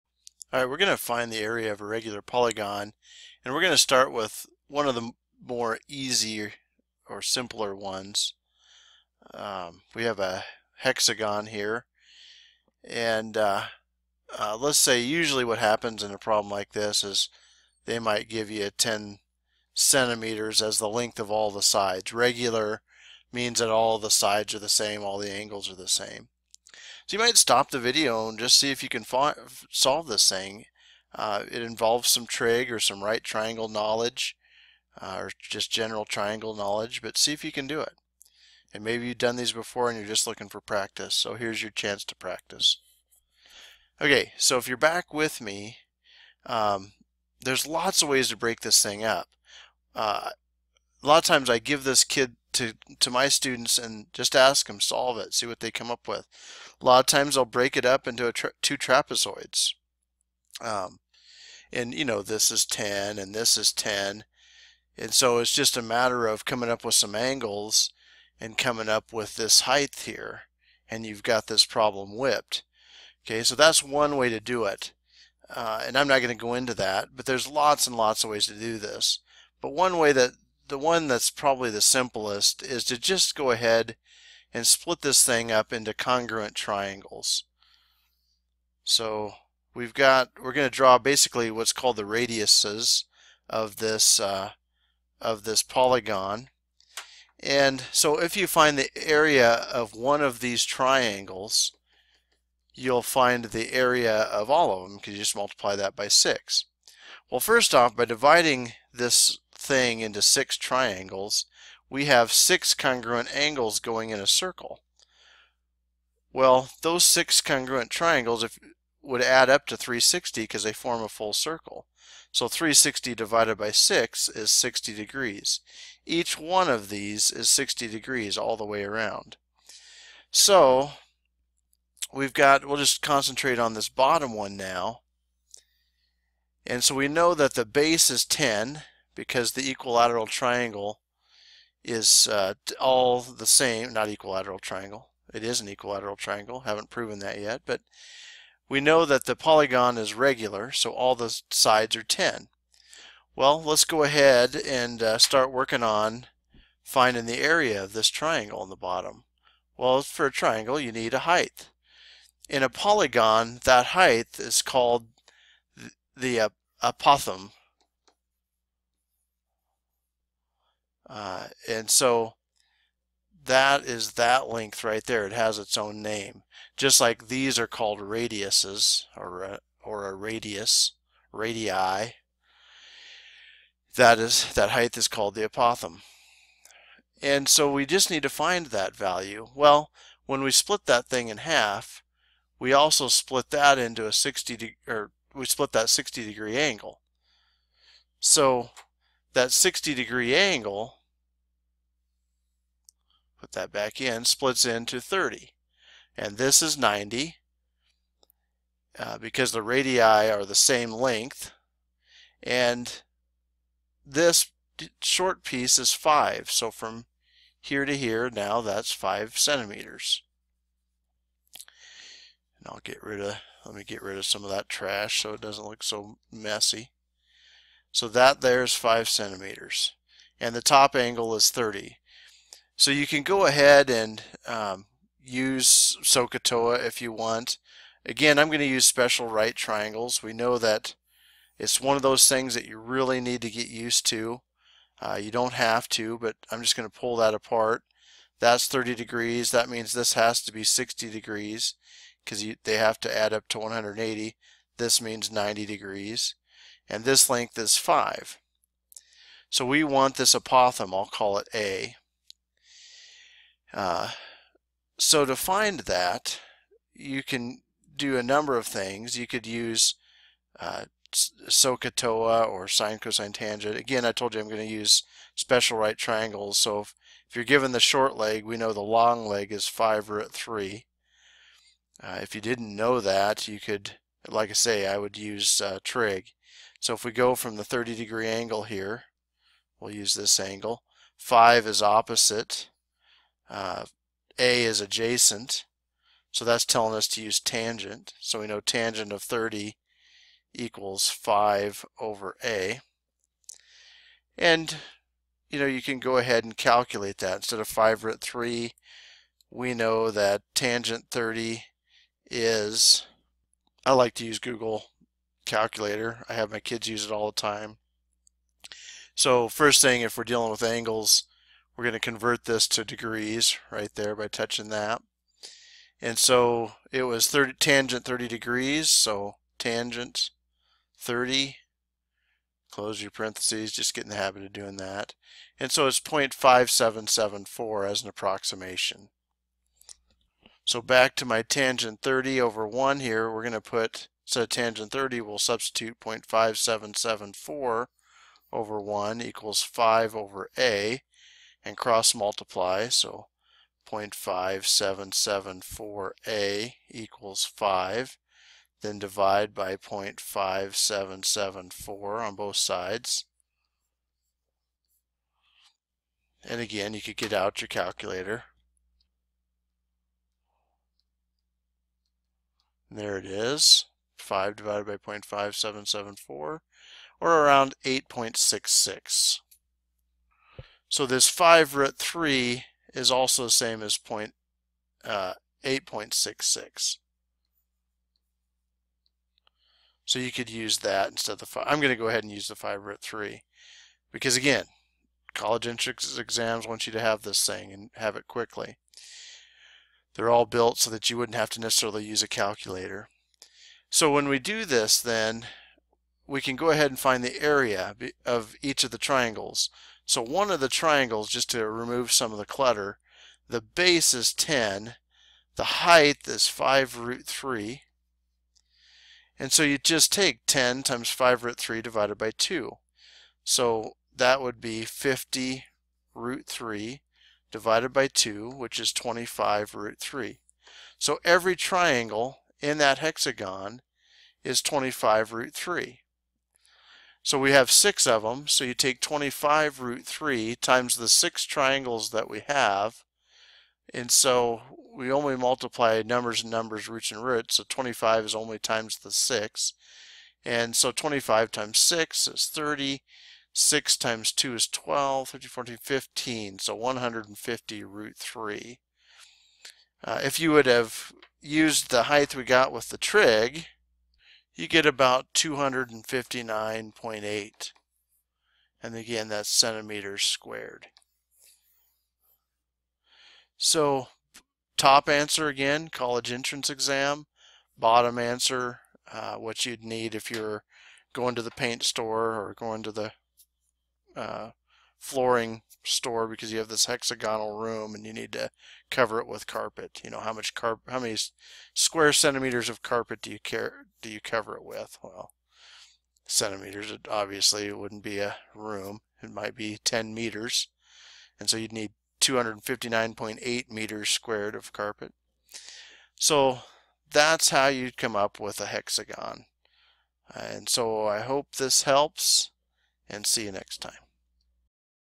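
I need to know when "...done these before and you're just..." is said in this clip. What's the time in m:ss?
0:39.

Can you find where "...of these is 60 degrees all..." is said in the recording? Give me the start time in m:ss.
2:06.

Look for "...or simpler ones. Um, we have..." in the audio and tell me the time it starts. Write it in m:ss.
0:07.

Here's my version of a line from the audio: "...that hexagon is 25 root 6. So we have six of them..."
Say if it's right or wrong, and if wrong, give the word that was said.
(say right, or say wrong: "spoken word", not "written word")
wrong: "3", not "6".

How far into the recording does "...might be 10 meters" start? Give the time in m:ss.
8:19.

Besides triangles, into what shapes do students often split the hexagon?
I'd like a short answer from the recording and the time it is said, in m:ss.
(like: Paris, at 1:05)
two trapezoids, at 0:58.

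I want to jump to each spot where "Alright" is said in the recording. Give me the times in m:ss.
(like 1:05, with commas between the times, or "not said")
0:00.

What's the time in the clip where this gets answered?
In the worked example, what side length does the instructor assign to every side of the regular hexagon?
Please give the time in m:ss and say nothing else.
0:18.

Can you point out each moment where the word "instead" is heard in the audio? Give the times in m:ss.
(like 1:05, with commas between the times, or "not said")
5:07, 5:44, 6:31.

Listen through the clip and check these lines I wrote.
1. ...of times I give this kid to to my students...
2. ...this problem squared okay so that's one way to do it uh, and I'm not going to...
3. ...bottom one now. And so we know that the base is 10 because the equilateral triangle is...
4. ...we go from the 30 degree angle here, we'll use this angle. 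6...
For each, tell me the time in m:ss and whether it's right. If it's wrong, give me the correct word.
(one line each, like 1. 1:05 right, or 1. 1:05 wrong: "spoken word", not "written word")
1. 0:51 right
2. 1:11 wrong: "whipped", not "squared"
3. 2:13 right
4. 4:47 wrong: "5", not "6".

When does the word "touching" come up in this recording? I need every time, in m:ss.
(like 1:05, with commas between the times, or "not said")
5:24.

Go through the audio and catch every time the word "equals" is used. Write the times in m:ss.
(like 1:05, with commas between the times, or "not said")
5:00, 5:49, 5:56.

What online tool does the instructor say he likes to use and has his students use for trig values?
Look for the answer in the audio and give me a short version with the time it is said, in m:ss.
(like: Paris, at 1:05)
Google Calculator, at 5:14.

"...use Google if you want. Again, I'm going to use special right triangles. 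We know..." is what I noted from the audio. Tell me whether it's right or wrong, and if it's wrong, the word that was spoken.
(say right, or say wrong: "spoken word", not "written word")
wrong: "SOHCAHTOA", not "Google".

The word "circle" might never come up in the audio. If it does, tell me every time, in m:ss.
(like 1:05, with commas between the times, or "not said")
1:54, 2:01.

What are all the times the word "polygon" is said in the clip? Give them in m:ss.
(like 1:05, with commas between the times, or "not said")
0:02, 1:35, 2:29, 2:42.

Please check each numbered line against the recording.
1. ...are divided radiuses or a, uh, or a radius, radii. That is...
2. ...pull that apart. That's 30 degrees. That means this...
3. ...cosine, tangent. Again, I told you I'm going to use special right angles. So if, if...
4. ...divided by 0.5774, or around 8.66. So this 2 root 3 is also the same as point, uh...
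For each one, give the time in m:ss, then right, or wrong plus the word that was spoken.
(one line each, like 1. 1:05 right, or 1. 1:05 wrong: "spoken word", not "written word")
1. 2:57 wrong: "called", not "divided"
2. 4:06 right
3. 4:32 wrong: "triangles", not "angles"
4. 6:14 wrong: "5", not "2".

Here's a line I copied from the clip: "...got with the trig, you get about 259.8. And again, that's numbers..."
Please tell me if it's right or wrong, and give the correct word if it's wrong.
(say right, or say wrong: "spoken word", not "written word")
wrong: "centimeters", not "numbers".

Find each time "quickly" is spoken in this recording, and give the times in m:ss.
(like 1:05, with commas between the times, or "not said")
6:38.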